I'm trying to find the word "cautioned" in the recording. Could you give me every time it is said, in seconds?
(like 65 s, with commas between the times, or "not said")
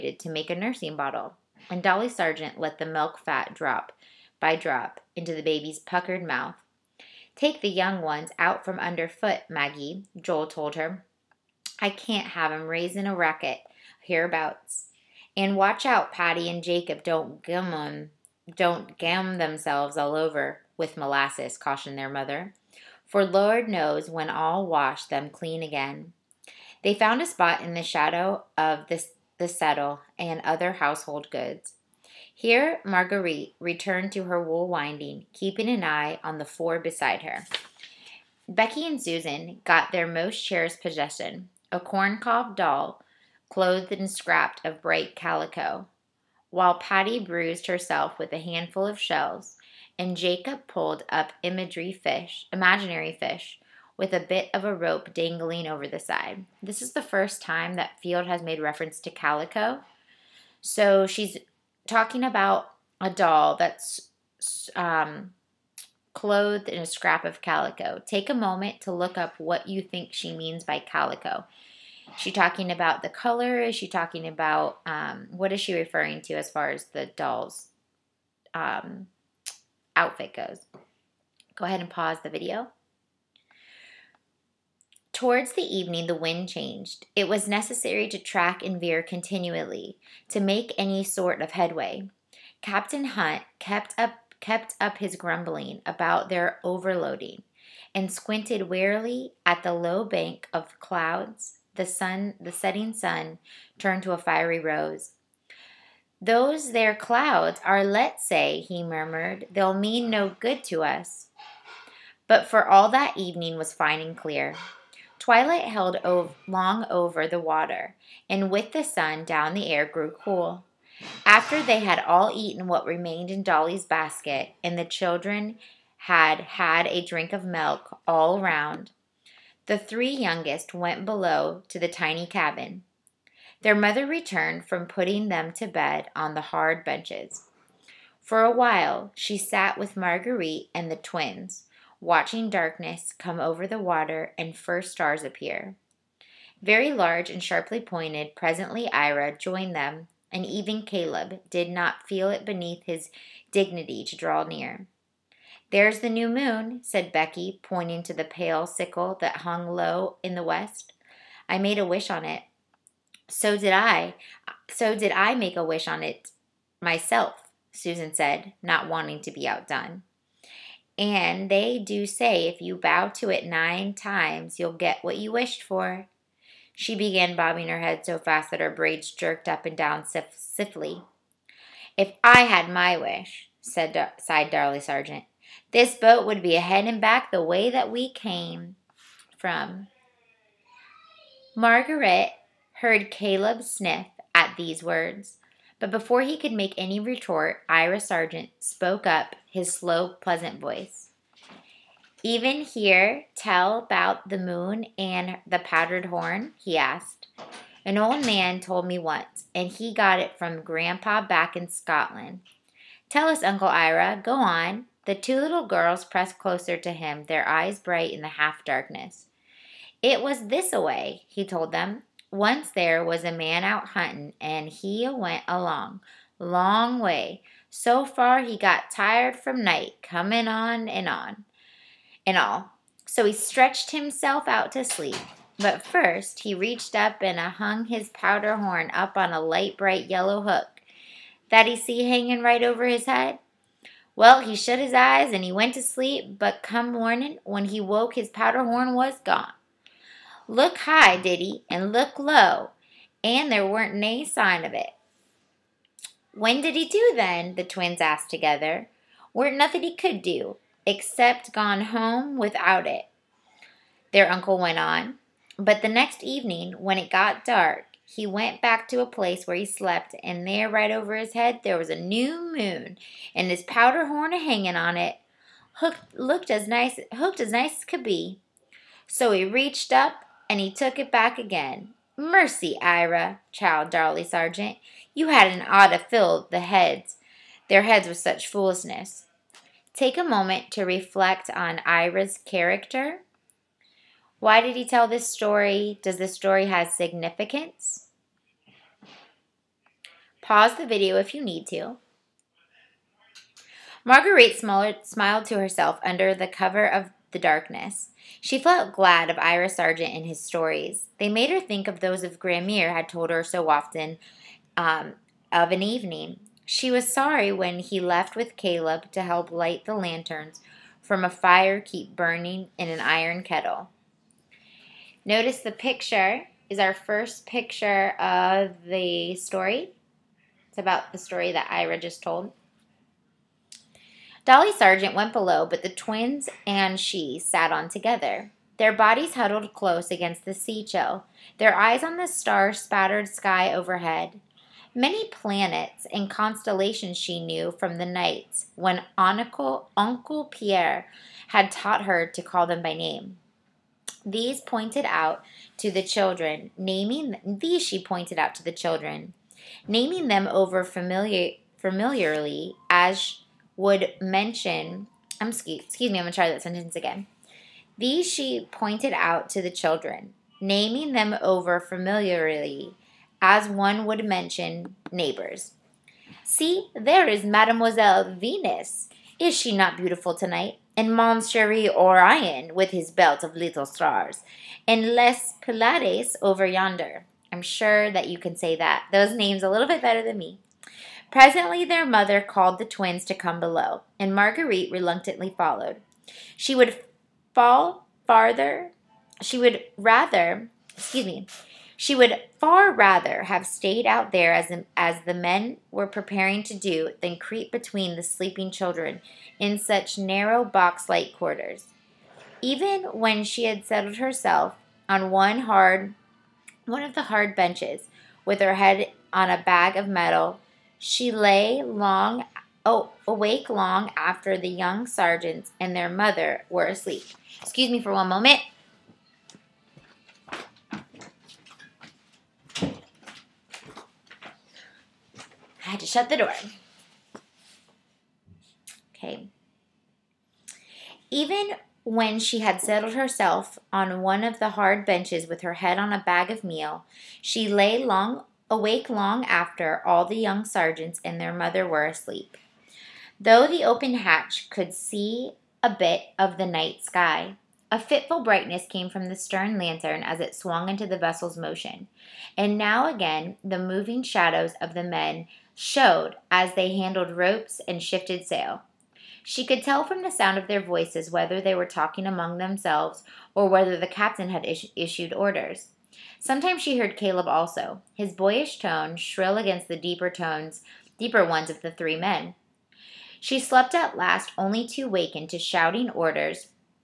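21 s.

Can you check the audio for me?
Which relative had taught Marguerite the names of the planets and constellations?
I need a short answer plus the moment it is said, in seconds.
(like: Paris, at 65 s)
Uncle Pierre, at 349 s.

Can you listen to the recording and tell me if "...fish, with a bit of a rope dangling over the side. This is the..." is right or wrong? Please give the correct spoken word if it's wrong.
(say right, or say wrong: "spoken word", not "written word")
right.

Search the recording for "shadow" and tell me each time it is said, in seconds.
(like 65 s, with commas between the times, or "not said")
27 s, 464 s.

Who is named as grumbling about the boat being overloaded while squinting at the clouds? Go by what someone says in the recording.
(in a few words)
Captain Hunt.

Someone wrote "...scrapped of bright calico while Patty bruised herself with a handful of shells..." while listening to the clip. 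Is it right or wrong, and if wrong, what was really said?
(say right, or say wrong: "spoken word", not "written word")
right.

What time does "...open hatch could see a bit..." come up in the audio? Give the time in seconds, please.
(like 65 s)
453 s.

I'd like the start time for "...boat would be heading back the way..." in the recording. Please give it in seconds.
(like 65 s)
185 s.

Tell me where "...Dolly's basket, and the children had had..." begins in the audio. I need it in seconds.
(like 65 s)
123 s.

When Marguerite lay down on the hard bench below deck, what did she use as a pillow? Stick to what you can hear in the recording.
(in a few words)
a bag of meal.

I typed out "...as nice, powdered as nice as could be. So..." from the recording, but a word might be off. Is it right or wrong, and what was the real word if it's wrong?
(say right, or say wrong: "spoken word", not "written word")
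wrong: "hooked", not "powdered".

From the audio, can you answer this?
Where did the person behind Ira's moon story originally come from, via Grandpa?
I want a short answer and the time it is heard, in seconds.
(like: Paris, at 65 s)
Scotland, at 211 s.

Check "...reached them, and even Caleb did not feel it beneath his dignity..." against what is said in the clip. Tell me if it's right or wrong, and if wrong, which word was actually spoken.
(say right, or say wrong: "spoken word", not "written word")
wrong: "joined", not "reached".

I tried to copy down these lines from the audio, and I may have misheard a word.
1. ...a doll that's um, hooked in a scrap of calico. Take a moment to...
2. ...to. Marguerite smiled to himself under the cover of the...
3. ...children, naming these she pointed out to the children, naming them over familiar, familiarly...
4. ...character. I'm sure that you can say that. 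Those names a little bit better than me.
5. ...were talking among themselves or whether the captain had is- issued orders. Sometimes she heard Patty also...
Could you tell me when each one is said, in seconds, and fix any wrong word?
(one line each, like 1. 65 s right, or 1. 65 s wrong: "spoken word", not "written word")
1. 63 s wrong: "clothed", not "hooked"
2. 301 s wrong: "herself", not "himself"
3. 356 s right
4. 386 s wrong: "yonder", not "character"
5. 471 s wrong: "Caleb", not "Patty".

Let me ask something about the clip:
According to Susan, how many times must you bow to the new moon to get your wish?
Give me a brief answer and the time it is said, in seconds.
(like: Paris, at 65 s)
9, at 173 s.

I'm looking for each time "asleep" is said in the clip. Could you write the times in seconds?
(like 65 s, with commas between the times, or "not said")
426 s, 452 s.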